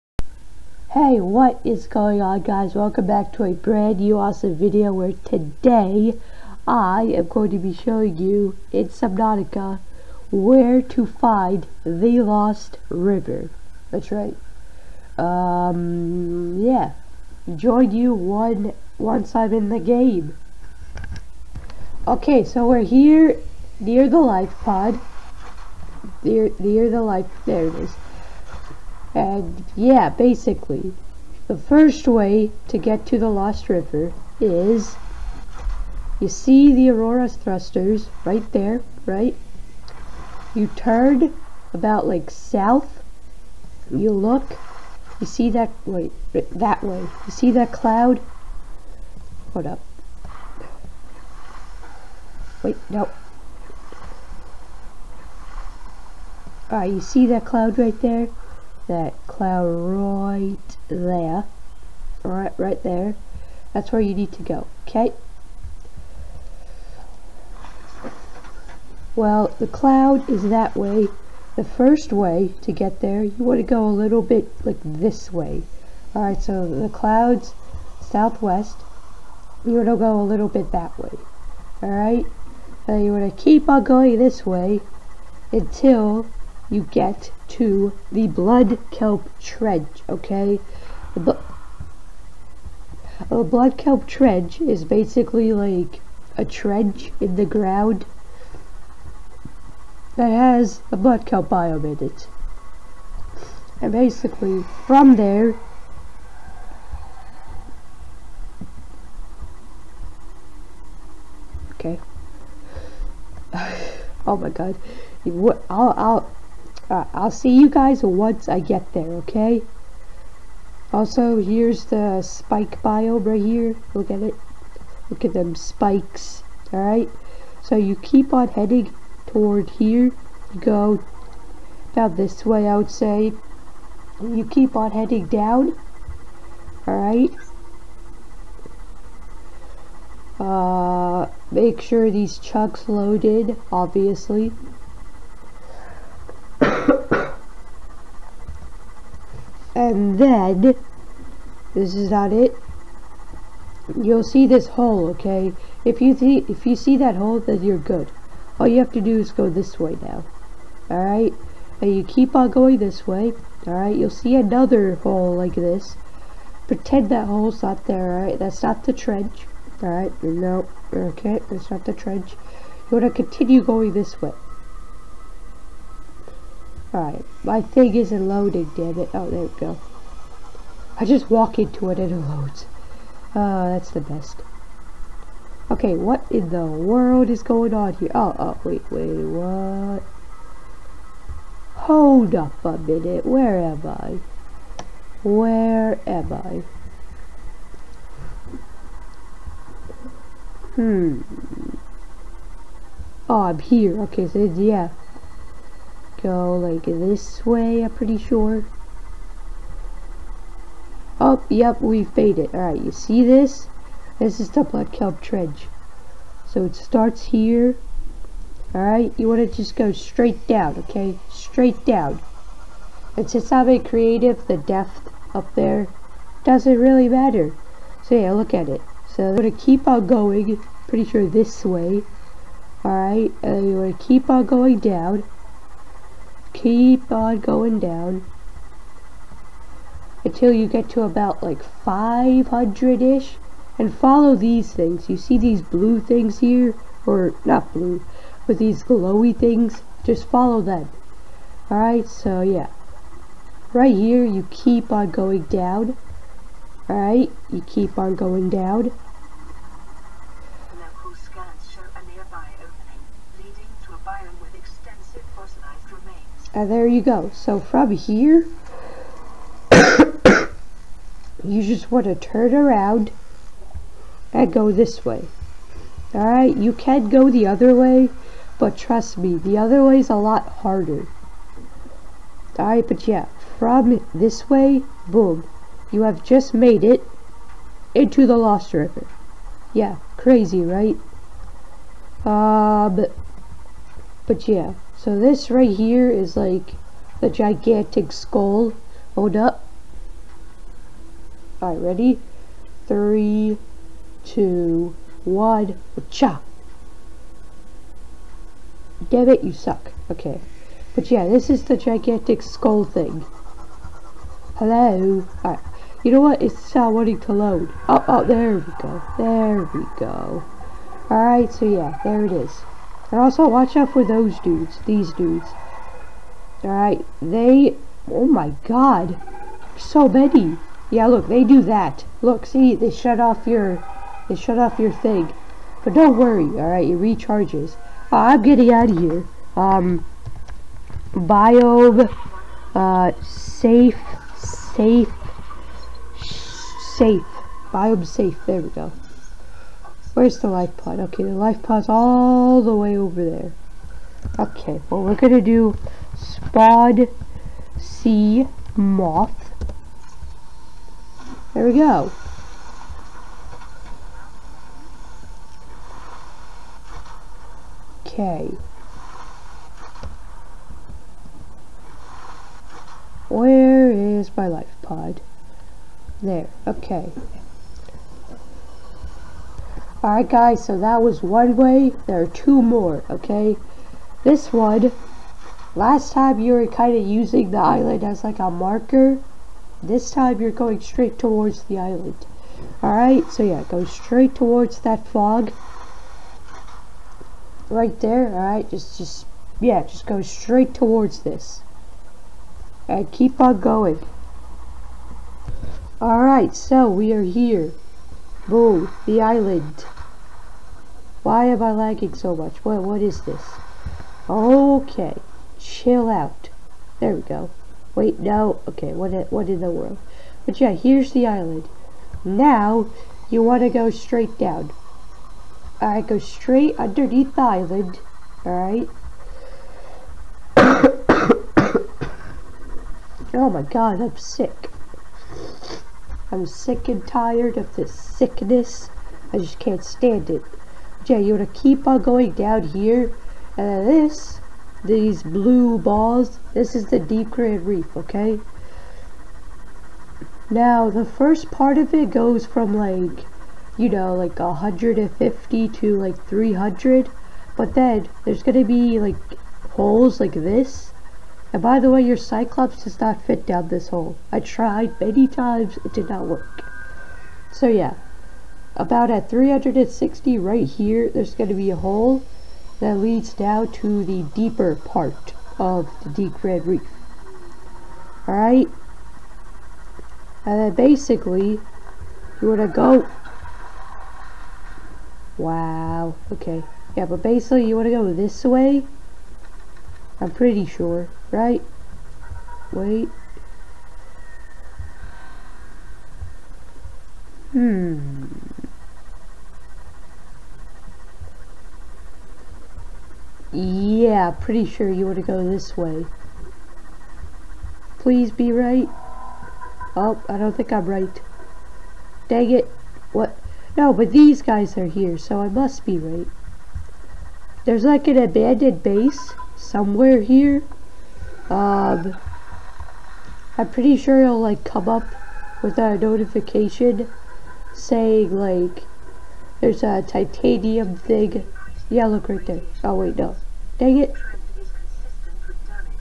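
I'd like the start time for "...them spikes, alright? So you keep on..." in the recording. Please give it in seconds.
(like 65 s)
125 s.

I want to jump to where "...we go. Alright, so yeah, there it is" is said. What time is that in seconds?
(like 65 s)
319 s.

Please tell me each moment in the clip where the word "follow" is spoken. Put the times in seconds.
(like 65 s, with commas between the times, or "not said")
243 s, 250 s.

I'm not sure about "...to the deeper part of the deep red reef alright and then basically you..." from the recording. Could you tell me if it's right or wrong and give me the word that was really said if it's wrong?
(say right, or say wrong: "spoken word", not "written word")
right.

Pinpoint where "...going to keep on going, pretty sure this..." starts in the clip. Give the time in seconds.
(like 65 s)
229 s.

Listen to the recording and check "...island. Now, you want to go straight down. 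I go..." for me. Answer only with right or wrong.
right.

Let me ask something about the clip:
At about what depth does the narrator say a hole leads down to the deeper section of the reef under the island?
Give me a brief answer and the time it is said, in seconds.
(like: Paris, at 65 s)
360, at 469 s.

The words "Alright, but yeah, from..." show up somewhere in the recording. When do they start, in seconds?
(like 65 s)
282 s.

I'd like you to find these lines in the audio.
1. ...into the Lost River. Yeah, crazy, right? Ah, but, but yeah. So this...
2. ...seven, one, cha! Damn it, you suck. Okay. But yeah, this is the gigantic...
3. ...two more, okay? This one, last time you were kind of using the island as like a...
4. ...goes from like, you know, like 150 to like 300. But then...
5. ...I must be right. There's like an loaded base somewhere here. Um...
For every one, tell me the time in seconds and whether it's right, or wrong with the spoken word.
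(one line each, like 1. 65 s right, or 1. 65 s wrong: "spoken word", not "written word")
1. 287 s right
2. 304 s wrong: "two", not "seven"
3. 382 s right
4. 452 s right
5. 515 s wrong: "abandoned", not "loaded".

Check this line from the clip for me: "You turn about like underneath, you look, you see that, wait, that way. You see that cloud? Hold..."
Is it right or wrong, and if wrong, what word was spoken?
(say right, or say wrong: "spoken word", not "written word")
wrong: "south", not "underneath".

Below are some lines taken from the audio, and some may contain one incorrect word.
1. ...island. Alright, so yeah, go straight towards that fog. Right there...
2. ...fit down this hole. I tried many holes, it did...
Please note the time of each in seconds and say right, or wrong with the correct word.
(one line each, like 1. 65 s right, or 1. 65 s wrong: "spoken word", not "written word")
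1. 391 s right
2. 463 s wrong: "times", not "holes".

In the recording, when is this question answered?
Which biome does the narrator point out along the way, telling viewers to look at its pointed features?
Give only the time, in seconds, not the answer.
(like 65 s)
122 s.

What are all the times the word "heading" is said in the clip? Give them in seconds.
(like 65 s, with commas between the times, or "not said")
128 s, 134 s.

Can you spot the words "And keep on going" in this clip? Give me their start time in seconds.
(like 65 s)
402 s.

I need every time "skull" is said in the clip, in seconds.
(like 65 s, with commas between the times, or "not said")
298 s, 312 s.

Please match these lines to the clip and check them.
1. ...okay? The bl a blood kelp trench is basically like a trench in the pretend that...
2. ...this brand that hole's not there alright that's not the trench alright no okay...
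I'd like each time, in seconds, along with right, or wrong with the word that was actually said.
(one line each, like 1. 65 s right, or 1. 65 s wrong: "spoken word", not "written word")
1. 90 s wrong: "ground", not "pretend"
2. 165 s wrong: "pretend", not "brand".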